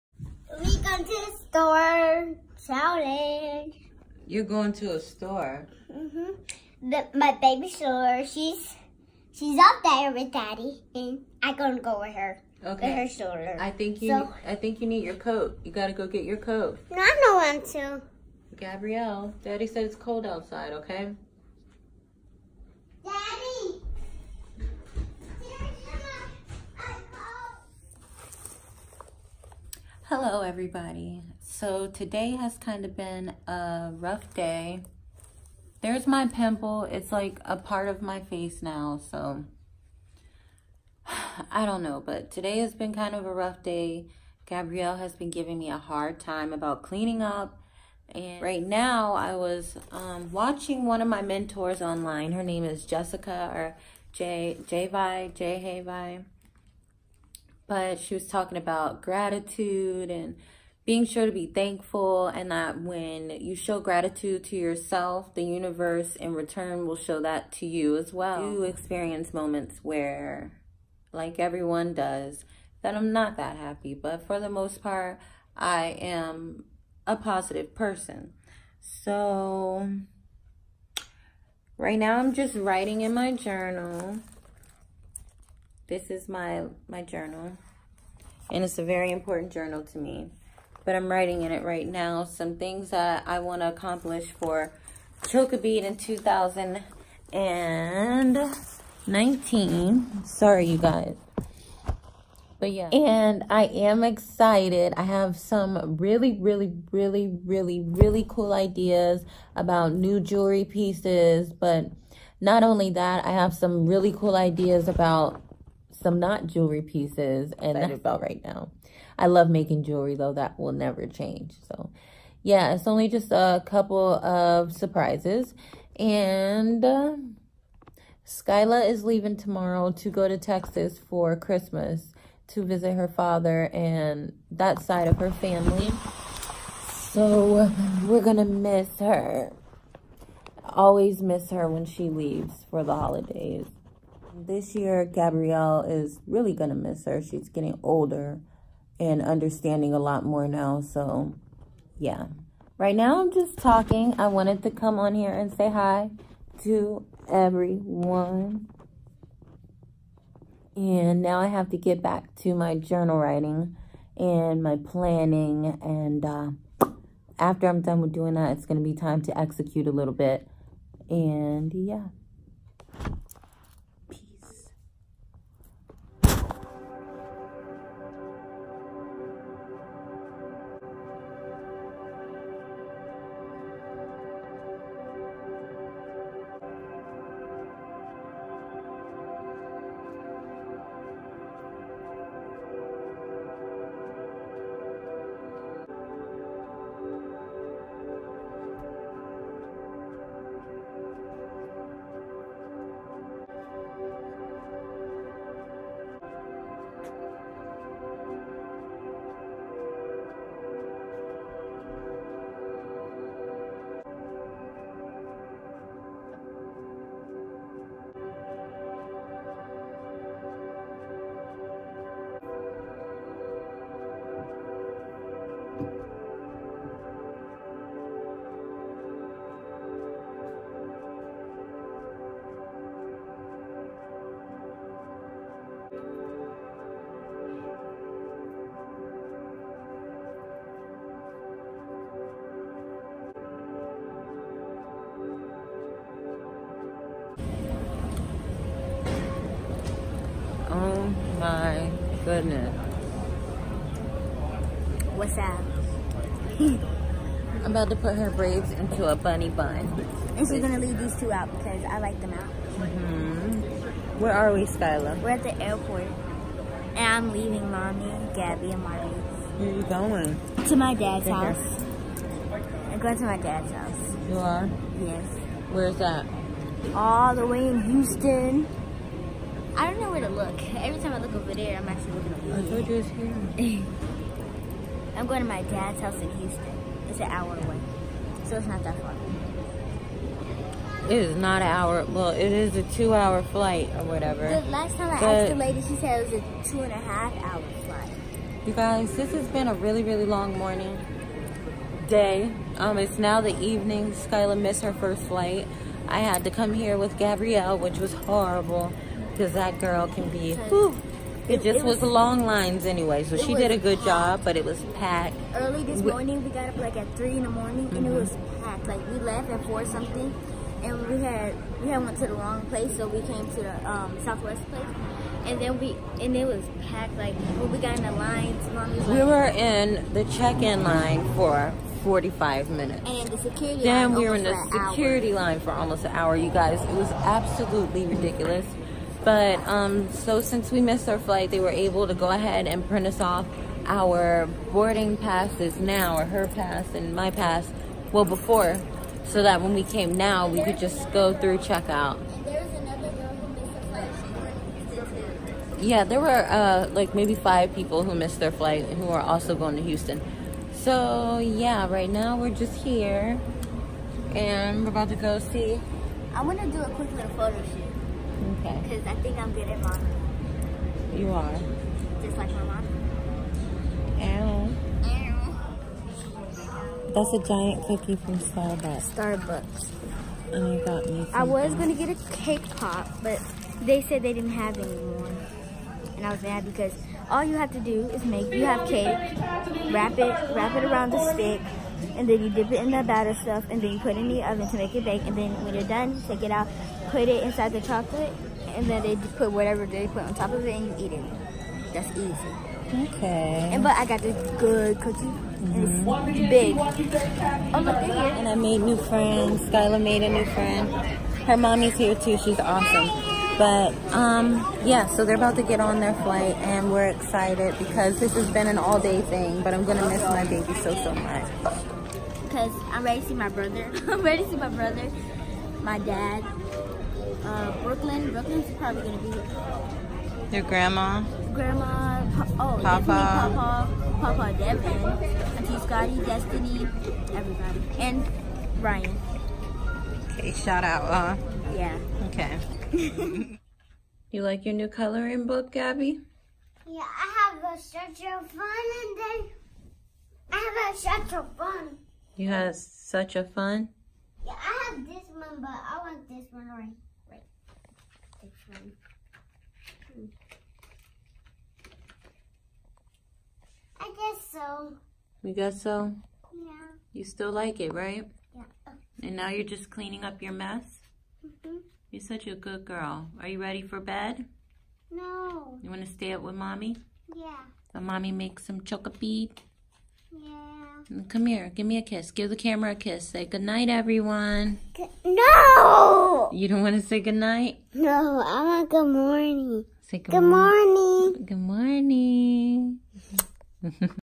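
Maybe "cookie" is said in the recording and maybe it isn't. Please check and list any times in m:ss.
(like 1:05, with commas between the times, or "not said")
6:17, 6:44.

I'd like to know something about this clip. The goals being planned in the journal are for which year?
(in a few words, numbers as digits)
2019.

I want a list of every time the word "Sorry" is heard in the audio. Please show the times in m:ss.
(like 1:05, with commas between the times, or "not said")
1:40.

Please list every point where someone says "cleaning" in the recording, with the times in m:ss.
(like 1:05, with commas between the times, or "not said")
0:46, 7:49.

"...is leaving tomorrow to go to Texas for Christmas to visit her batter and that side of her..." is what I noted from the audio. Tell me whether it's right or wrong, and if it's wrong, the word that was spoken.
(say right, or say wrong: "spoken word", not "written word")
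wrong: "father", not "batter".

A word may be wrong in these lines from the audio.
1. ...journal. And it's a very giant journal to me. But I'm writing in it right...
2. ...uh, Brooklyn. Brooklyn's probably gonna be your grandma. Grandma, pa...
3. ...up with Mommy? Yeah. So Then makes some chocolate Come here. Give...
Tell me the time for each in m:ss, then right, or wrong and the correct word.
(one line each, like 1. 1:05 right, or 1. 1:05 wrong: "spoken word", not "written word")
1. 1:27 wrong: "important", not "giant"
2. 7:07 right
3. 7:56 wrong: "Mommy", not "Then".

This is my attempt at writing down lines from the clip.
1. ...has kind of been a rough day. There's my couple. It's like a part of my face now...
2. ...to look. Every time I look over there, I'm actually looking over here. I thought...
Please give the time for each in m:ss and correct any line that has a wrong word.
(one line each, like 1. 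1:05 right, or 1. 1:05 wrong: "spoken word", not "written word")
1. 0:32 wrong: "pimple", not "couple"
2. 4:40 right.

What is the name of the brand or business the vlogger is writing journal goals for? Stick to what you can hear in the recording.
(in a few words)
Chocobeat.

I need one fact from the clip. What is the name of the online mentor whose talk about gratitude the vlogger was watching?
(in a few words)
Jessica.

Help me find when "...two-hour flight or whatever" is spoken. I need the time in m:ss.
4:52.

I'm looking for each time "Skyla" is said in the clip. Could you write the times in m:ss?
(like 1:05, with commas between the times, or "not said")
2:08, 4:24, 5:04, 6:49.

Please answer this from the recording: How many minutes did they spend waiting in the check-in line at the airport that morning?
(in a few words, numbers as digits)
45.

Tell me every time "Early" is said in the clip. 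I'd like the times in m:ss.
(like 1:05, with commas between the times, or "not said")
5:15.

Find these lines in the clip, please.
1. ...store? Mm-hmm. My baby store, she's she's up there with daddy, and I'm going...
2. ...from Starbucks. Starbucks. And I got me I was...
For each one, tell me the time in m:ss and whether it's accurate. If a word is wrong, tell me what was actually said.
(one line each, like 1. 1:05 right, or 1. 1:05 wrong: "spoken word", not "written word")
1. 0:04 right
2. 6:18 right.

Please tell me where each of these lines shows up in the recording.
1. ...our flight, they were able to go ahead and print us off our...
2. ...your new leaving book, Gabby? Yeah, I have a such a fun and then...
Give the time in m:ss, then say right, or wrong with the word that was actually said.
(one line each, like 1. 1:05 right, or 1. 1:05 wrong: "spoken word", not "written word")
1. 5:41 right
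2. 7:24 wrong: "coloring", not "leaving".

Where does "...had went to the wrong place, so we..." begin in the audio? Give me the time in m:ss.
5:21.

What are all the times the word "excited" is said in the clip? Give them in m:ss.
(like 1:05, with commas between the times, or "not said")
1:44, 6:57.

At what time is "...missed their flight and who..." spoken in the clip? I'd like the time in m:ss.
5:58.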